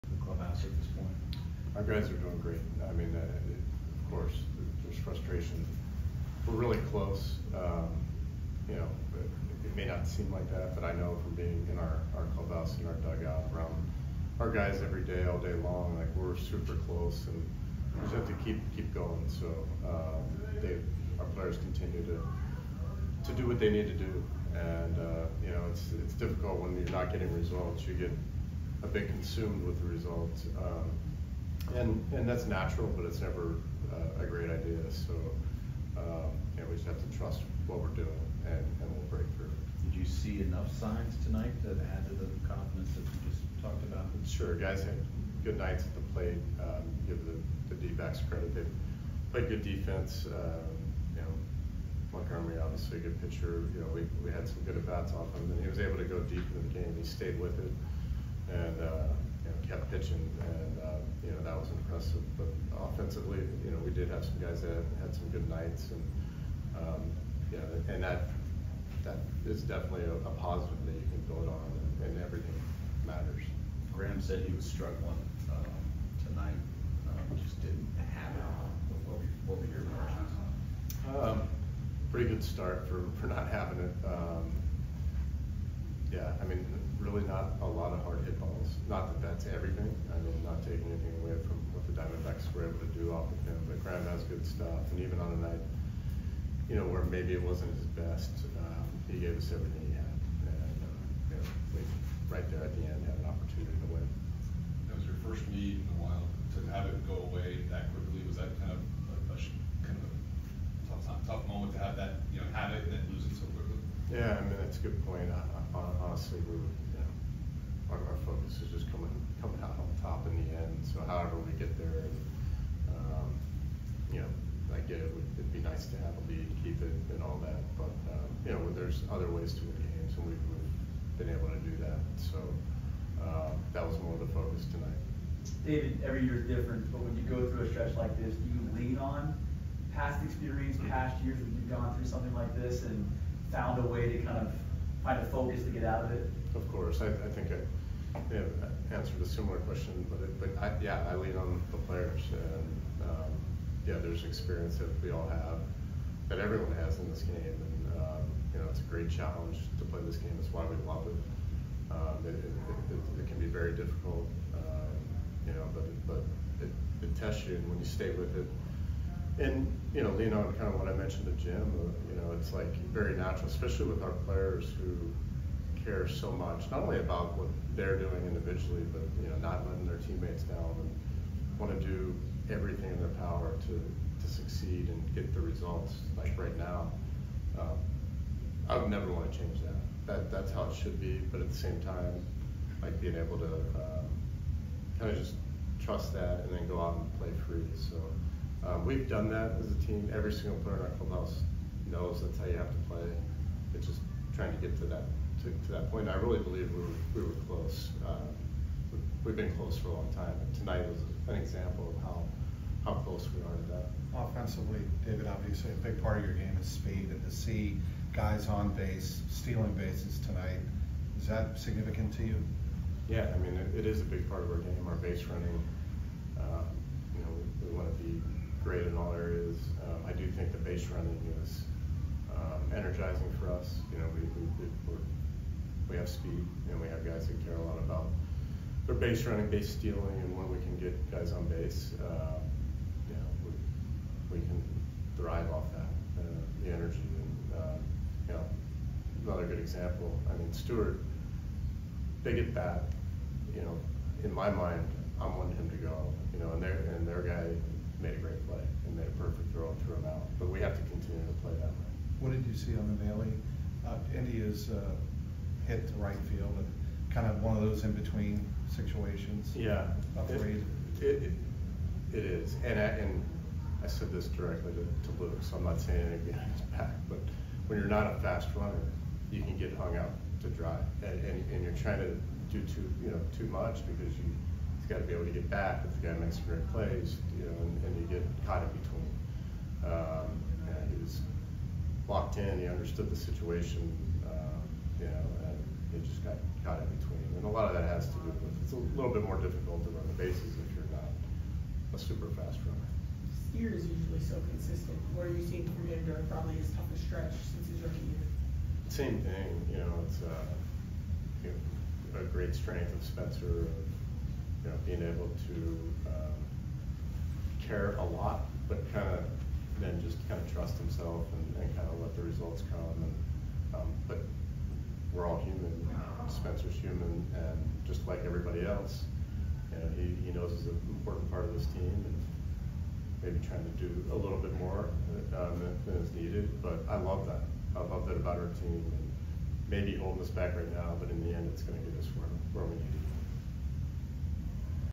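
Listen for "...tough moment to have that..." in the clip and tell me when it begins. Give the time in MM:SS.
01:51.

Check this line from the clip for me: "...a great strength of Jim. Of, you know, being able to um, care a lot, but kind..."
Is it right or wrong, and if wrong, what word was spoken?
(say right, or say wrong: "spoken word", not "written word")
wrong: "Spencer", not "Jim".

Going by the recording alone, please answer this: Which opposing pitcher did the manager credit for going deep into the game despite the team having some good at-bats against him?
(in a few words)
Montgomery.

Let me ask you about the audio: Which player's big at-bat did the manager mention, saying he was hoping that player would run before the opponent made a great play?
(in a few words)
Stuart.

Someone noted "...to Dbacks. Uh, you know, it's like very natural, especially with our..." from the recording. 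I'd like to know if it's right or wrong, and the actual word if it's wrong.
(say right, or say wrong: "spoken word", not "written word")
wrong: "Jim", not "Dbacks".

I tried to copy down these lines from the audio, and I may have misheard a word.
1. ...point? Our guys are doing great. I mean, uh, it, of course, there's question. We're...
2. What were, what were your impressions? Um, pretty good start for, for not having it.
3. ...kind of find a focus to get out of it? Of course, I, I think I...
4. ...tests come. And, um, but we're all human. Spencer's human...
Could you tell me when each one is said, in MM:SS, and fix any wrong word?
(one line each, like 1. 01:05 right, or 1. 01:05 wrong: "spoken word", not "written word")
1. 00:00 wrong: "frustration", not "question"
2. 01:19 right
3. 02:24 right
4. 05:22 wrong: "results", not "tests".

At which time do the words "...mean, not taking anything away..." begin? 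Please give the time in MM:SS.
01:30.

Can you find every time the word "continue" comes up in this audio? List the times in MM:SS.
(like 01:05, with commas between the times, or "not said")
00:21, 04:20.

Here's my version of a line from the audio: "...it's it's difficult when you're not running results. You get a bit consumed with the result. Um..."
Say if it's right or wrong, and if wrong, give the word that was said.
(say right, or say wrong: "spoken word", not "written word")
wrong: "getting", not "running".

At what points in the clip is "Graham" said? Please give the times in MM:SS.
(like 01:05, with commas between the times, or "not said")
01:13, 01:33.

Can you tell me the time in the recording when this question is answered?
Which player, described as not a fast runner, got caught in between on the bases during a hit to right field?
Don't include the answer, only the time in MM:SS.
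04:35.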